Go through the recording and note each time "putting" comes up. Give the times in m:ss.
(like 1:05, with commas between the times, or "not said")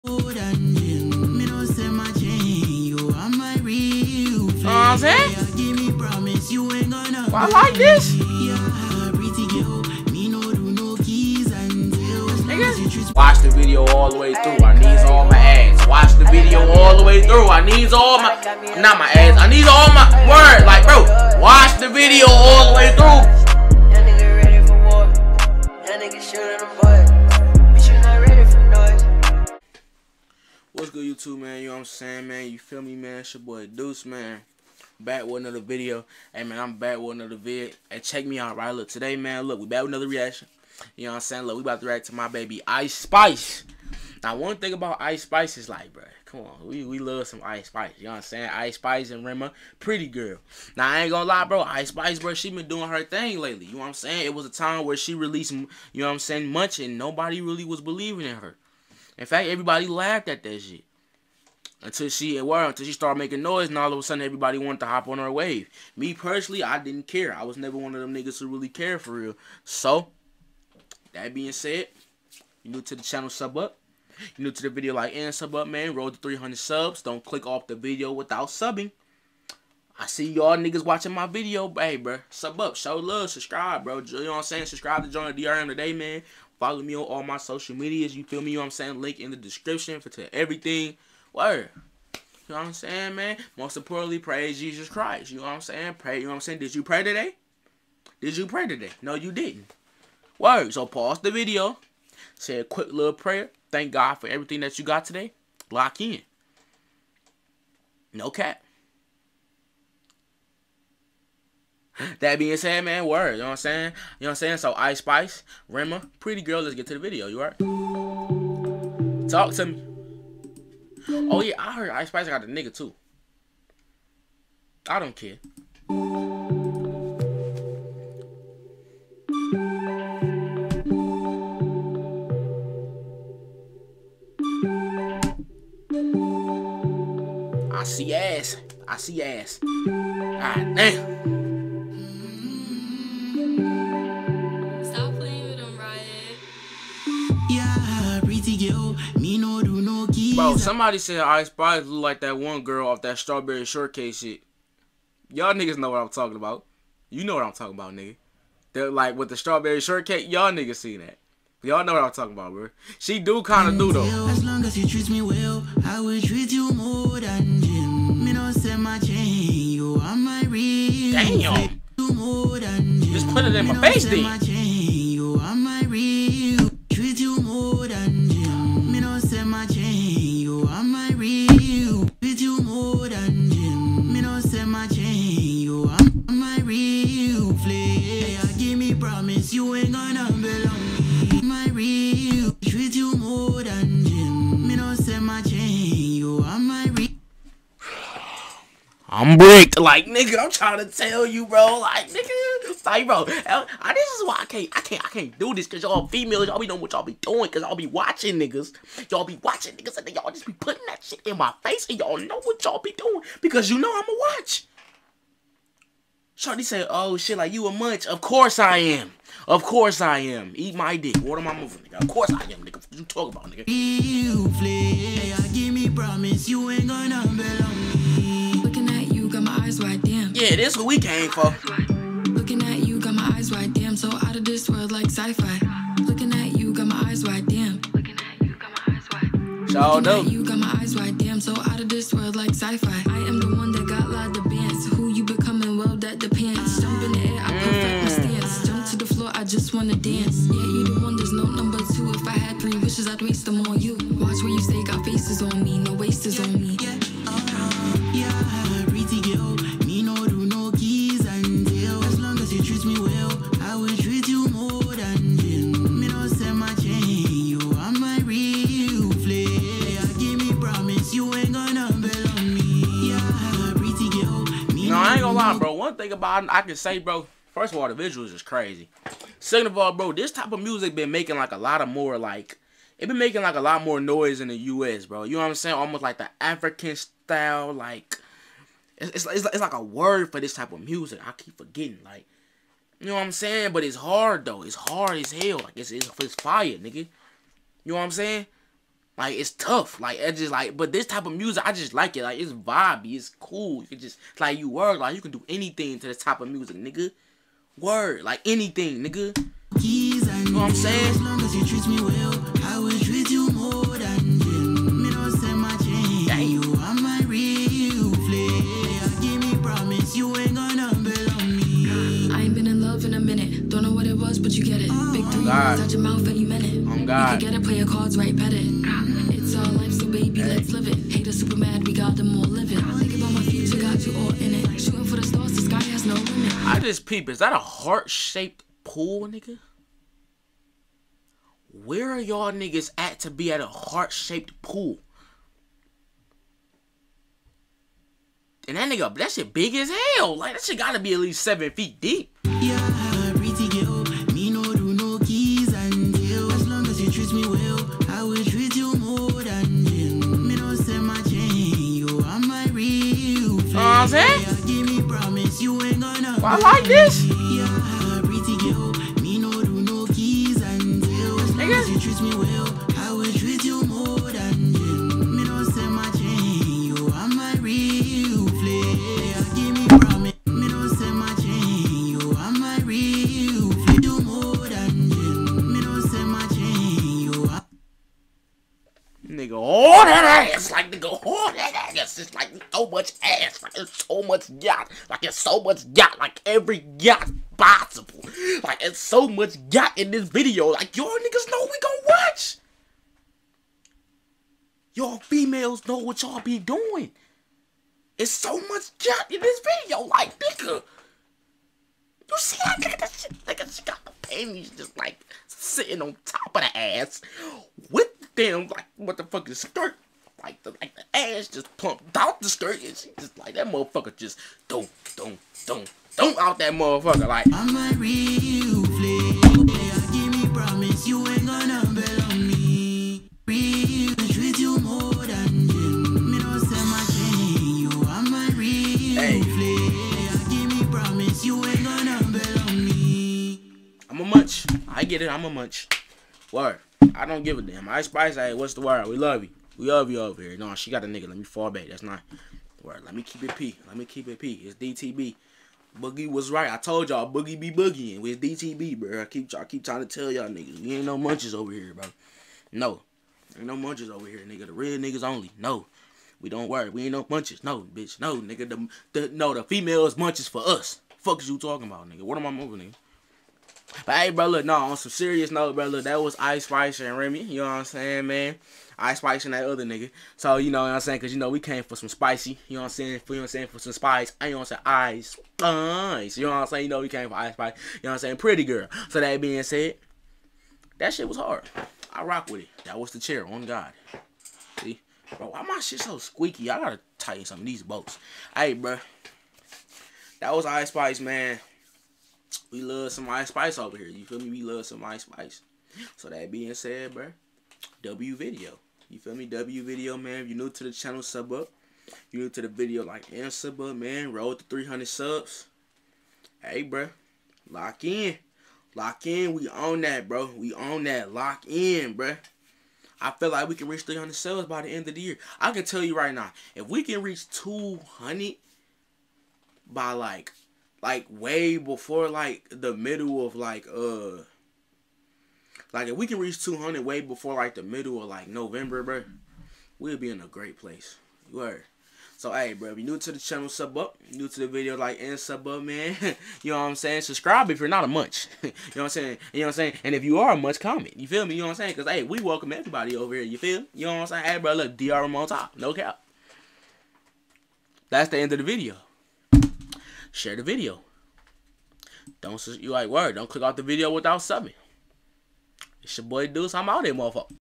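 3:30.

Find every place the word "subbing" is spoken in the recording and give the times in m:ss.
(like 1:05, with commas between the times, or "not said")
1:18, 9:24.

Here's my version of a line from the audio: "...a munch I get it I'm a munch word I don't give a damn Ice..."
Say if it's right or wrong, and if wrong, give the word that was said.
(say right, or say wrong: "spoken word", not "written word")
right.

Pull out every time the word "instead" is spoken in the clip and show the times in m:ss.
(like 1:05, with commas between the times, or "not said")
not said.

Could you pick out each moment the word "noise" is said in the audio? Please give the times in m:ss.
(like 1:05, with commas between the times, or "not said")
1:03, 4:43.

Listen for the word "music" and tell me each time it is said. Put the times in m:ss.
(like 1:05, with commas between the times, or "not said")
4:40, 4:50, 5:01, 5:06.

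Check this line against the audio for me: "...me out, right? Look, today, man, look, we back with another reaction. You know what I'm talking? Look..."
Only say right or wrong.
wrong.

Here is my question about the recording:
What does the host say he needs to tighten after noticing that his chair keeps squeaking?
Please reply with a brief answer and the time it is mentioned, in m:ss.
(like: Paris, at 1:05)
Bolts, at 8:17.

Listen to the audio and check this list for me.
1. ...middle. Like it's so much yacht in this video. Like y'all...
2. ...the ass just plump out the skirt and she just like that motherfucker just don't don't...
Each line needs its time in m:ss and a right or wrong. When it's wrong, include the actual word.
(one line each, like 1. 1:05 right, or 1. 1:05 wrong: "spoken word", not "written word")
1. 6:37 wrong: "possible", not "middle"
2. 7:00 right.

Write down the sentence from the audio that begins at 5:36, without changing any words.
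I just peep, is that a heart-shaped pool, nigga?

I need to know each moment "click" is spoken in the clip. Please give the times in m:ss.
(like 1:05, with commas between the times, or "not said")
1:17, 9:23.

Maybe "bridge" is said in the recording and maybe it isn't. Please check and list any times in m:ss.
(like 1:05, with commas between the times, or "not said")
not said.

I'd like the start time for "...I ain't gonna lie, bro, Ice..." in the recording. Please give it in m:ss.
0:50.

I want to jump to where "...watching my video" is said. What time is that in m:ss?
1:20.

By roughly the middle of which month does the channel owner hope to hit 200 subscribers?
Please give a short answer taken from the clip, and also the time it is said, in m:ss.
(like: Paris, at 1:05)
November, at 8:58.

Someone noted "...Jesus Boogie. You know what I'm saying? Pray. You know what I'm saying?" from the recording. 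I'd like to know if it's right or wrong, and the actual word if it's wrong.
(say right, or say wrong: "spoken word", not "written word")
wrong: "Christ", not "Boogie".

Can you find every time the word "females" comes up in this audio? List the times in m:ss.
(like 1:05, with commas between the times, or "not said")
3:26, 6:45, 7:49.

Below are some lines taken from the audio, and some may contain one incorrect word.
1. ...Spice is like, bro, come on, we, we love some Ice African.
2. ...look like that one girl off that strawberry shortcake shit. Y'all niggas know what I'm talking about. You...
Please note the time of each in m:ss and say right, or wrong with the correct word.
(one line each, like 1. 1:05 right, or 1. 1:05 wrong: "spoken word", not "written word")
1. 0:45 wrong: "Spice", not "African"
2. 2:31 right.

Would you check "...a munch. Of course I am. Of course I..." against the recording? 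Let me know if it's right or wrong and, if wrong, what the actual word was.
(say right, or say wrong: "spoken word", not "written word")
right.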